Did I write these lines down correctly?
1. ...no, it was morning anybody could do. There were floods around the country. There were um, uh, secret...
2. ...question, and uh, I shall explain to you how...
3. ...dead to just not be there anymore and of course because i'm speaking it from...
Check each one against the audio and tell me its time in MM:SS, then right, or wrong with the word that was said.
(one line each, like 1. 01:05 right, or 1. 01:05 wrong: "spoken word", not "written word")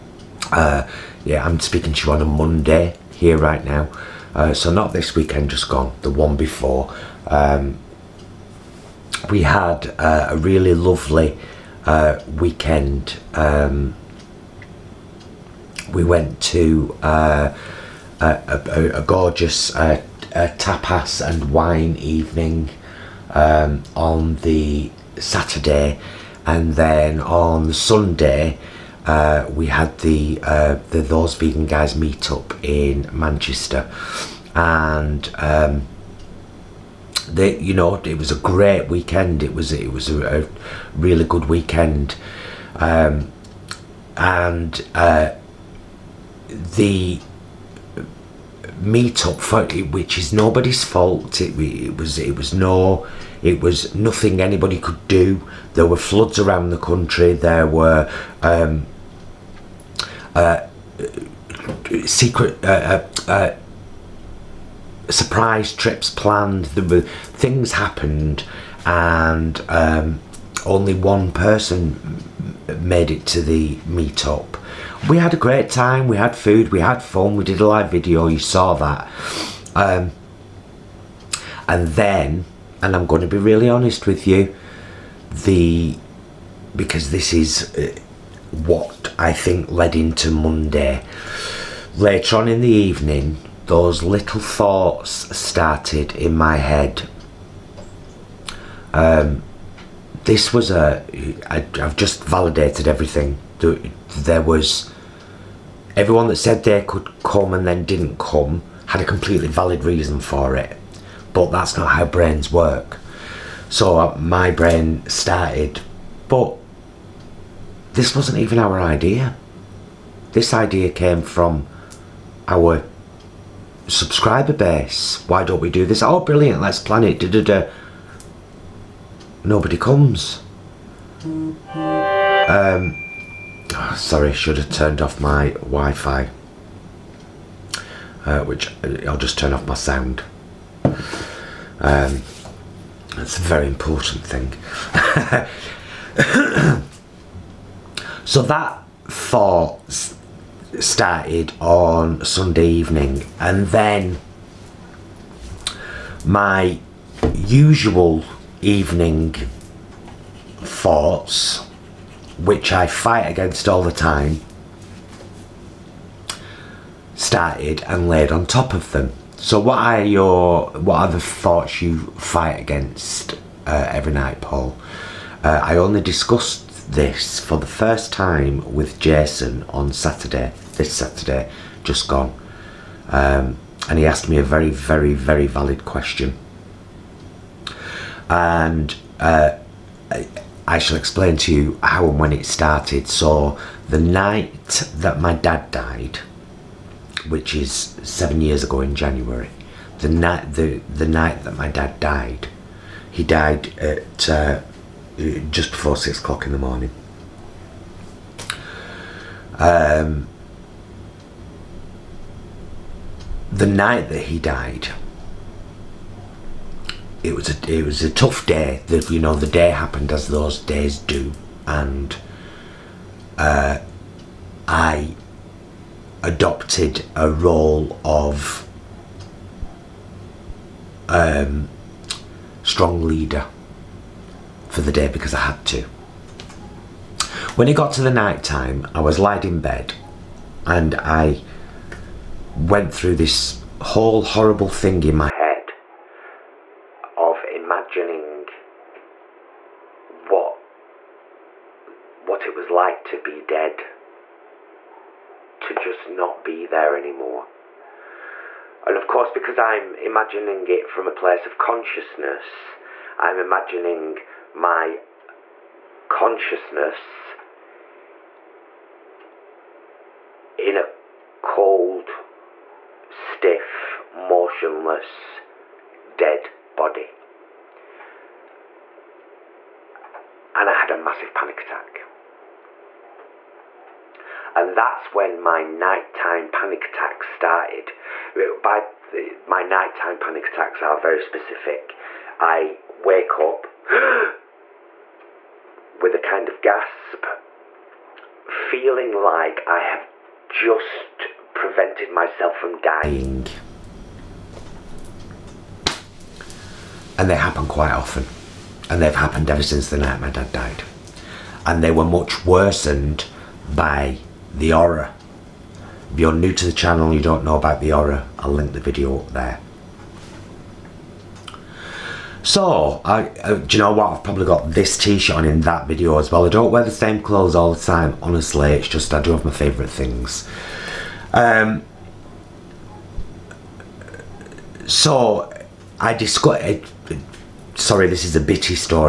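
1. 00:52 wrong: "nothing", not "morning"
2. 03:05 right
3. 04:13 wrong: "imagining", not "speaking".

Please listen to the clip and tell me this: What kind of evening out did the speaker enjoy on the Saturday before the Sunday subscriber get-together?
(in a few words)
tapas and wine.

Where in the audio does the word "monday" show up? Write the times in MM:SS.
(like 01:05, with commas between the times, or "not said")
00:02, 01:30.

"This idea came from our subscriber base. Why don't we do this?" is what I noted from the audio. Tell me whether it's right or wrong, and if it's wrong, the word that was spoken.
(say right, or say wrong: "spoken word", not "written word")
right.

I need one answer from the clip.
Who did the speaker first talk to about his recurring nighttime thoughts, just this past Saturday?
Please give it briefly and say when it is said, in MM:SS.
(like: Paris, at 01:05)
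Jason, at 02:58.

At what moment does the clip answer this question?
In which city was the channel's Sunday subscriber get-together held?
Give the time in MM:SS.
00:33.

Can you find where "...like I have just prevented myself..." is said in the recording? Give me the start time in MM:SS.
04:59.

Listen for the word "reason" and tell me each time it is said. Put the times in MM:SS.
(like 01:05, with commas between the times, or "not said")
01:49.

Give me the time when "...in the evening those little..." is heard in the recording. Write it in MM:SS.
01:32.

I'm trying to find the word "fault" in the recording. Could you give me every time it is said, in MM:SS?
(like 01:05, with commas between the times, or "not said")
00:50.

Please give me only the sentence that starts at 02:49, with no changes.
So what are your what are the thoughts you fight against uh, every night, Paul?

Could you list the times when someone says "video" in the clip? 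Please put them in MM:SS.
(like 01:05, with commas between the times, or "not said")
01:17, 05:18, 05:25.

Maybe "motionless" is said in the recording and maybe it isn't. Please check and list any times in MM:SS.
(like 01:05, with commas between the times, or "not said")
04:34.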